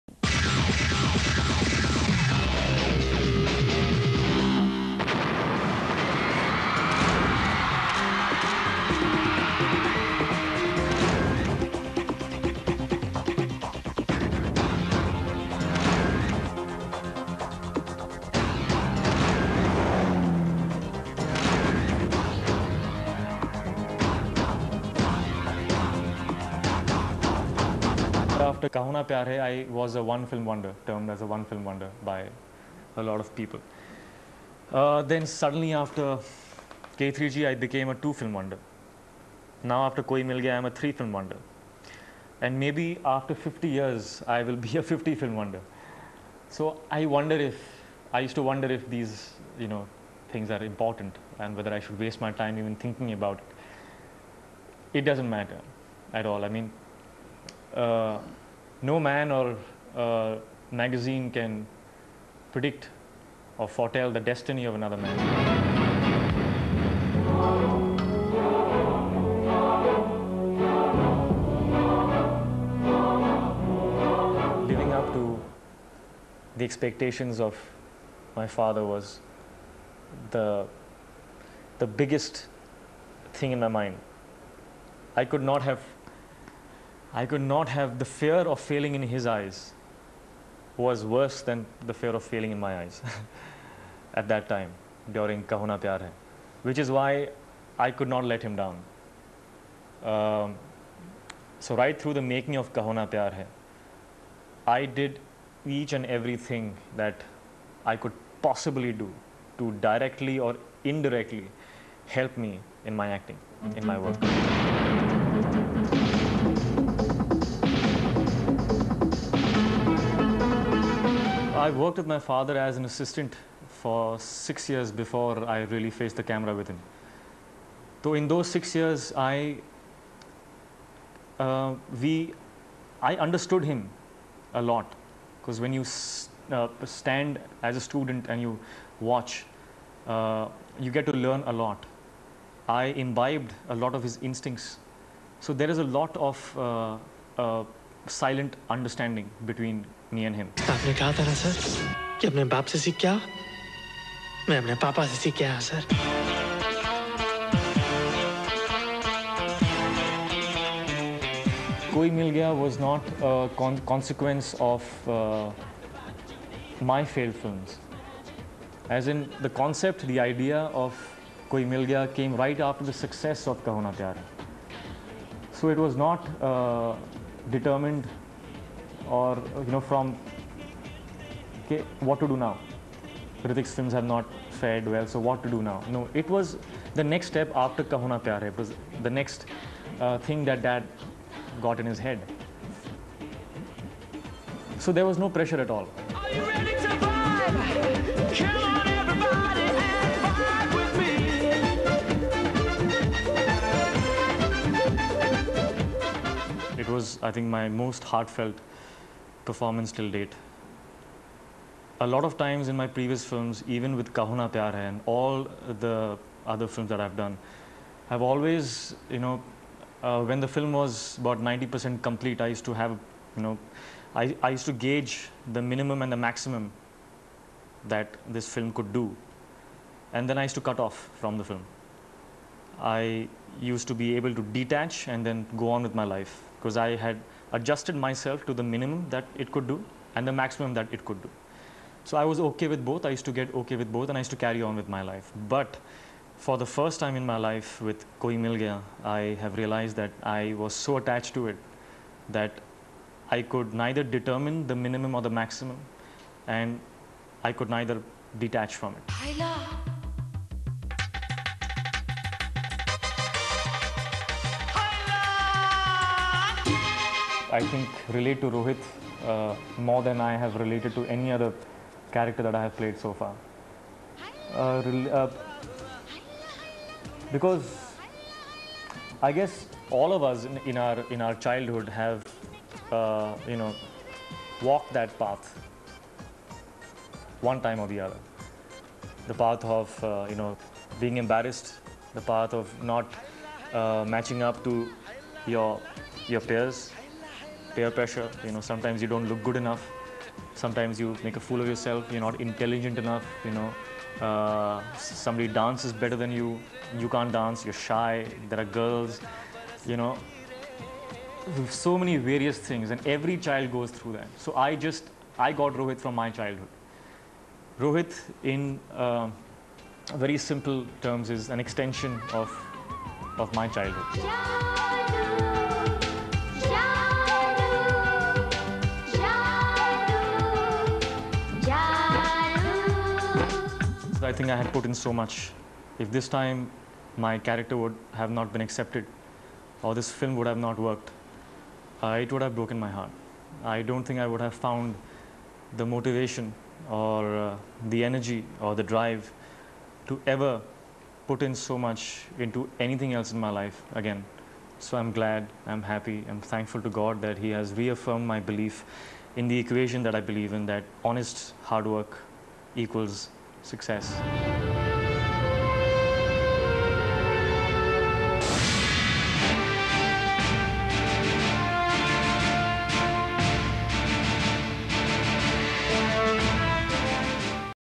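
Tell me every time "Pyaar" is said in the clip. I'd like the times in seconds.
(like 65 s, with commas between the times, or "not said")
29 s, 95 s, 103 s, 188 s, 214 s.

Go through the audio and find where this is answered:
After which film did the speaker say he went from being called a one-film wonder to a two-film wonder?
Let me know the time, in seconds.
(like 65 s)
36 s.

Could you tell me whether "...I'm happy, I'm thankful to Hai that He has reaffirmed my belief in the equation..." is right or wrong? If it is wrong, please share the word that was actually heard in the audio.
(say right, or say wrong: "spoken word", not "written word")
wrong: "God", not "Hai".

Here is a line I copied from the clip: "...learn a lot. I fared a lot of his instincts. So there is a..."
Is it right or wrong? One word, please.
wrong.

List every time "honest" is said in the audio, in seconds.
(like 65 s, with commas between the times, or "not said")
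361 s.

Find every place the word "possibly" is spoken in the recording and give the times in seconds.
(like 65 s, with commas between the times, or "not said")
108 s.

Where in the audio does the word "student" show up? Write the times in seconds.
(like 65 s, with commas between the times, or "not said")
137 s.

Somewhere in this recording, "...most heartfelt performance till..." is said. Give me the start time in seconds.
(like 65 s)
207 s.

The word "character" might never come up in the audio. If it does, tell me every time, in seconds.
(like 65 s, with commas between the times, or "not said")
272 s, 337 s.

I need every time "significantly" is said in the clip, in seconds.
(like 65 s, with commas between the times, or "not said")
not said.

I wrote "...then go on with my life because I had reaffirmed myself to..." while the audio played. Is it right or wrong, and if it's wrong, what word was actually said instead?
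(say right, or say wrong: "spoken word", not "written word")
wrong: "adjusted", not "reaffirmed".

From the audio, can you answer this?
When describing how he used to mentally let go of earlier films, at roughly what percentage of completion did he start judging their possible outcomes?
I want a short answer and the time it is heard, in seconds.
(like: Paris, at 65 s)
90%, at 221 s.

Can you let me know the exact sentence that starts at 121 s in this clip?
I worked with my father as an assistant for six years before I really faced the camera with him.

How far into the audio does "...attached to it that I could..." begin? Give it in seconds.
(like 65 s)
250 s.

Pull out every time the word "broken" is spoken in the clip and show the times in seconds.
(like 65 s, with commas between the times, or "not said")
342 s.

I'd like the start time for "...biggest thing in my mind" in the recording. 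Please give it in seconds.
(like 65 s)
81 s.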